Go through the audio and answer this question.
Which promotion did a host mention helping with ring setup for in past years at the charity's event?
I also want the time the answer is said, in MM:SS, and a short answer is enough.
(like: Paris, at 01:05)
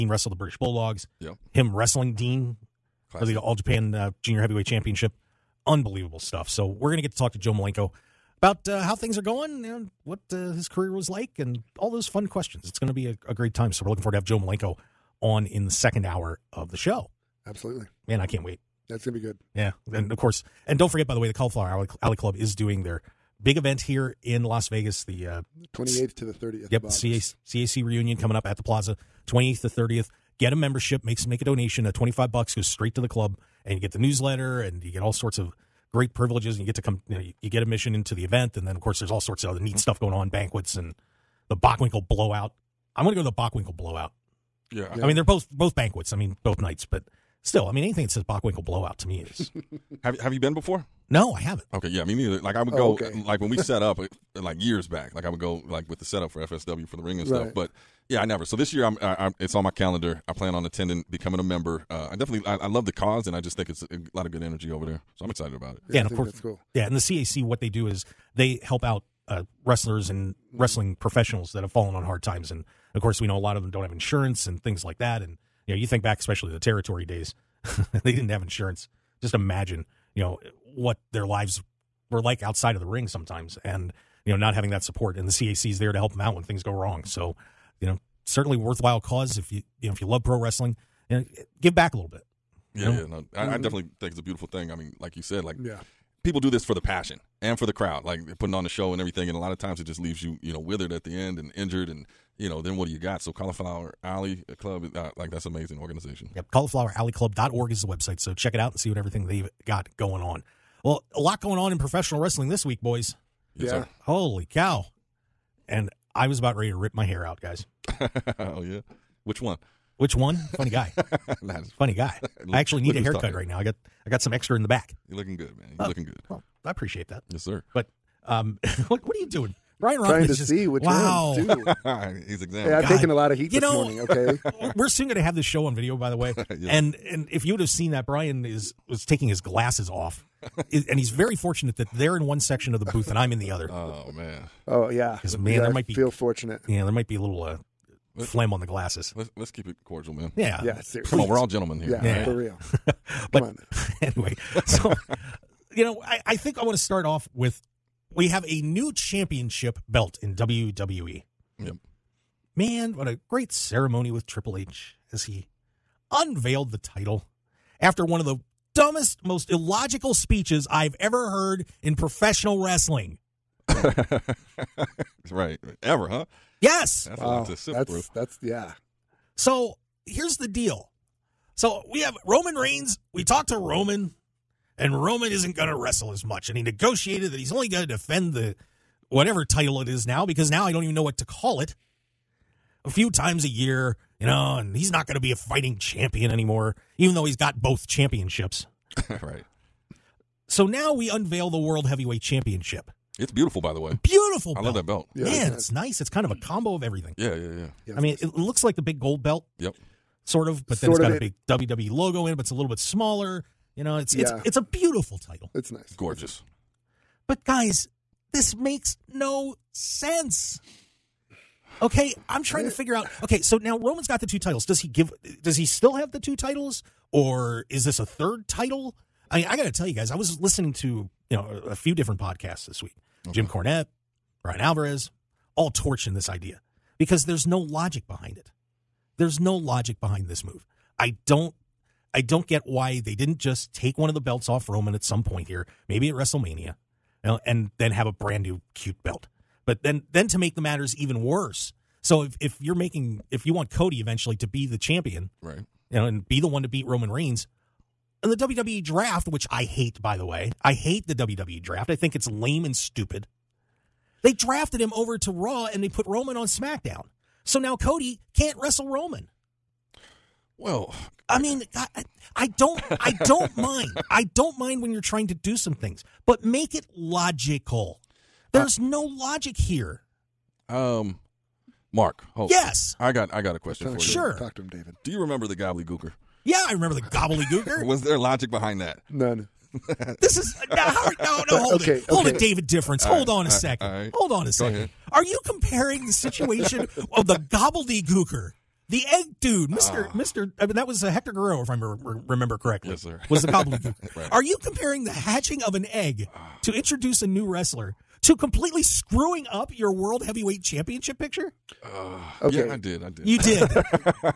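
FSW, at 00:56.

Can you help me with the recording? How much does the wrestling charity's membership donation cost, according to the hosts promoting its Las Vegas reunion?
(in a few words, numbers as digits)
$25.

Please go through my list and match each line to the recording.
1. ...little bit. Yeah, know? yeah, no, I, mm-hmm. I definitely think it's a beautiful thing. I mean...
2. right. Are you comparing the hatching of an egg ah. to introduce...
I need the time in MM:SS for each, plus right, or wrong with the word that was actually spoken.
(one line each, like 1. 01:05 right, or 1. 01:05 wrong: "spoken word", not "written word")
1. 01:31 right
2. 05:04 right.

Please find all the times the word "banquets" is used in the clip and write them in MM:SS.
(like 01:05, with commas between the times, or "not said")
00:40, 00:45.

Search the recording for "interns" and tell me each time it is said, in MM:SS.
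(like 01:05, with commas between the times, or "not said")
not said.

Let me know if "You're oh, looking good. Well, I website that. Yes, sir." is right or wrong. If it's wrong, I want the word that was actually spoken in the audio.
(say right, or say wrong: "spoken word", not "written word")
wrong: "appreciate", not "website".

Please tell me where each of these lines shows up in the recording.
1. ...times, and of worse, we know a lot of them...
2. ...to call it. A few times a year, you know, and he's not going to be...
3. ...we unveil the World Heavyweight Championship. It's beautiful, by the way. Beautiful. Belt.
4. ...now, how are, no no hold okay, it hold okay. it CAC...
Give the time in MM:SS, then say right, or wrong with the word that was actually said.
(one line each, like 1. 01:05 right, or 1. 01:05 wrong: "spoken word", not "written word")
1. 01:12 wrong: "course", not "worse"
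2. 03:11 right
3. 03:20 right
4. 04:50 wrong: "David", not "CAC".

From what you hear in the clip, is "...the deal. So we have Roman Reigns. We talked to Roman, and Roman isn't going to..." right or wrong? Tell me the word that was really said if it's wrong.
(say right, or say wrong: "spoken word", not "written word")
right.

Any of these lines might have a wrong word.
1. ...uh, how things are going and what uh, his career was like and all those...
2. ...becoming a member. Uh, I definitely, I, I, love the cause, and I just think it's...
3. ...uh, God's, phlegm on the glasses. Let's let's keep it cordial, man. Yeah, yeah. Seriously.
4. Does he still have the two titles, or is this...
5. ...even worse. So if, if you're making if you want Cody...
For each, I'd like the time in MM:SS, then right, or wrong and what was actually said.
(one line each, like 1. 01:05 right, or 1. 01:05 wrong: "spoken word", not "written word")
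1. 00:08 right
2. 01:01 right
3. 02:27 wrong: "Let", not "God"
4. 03:45 right
5. 04:10 right.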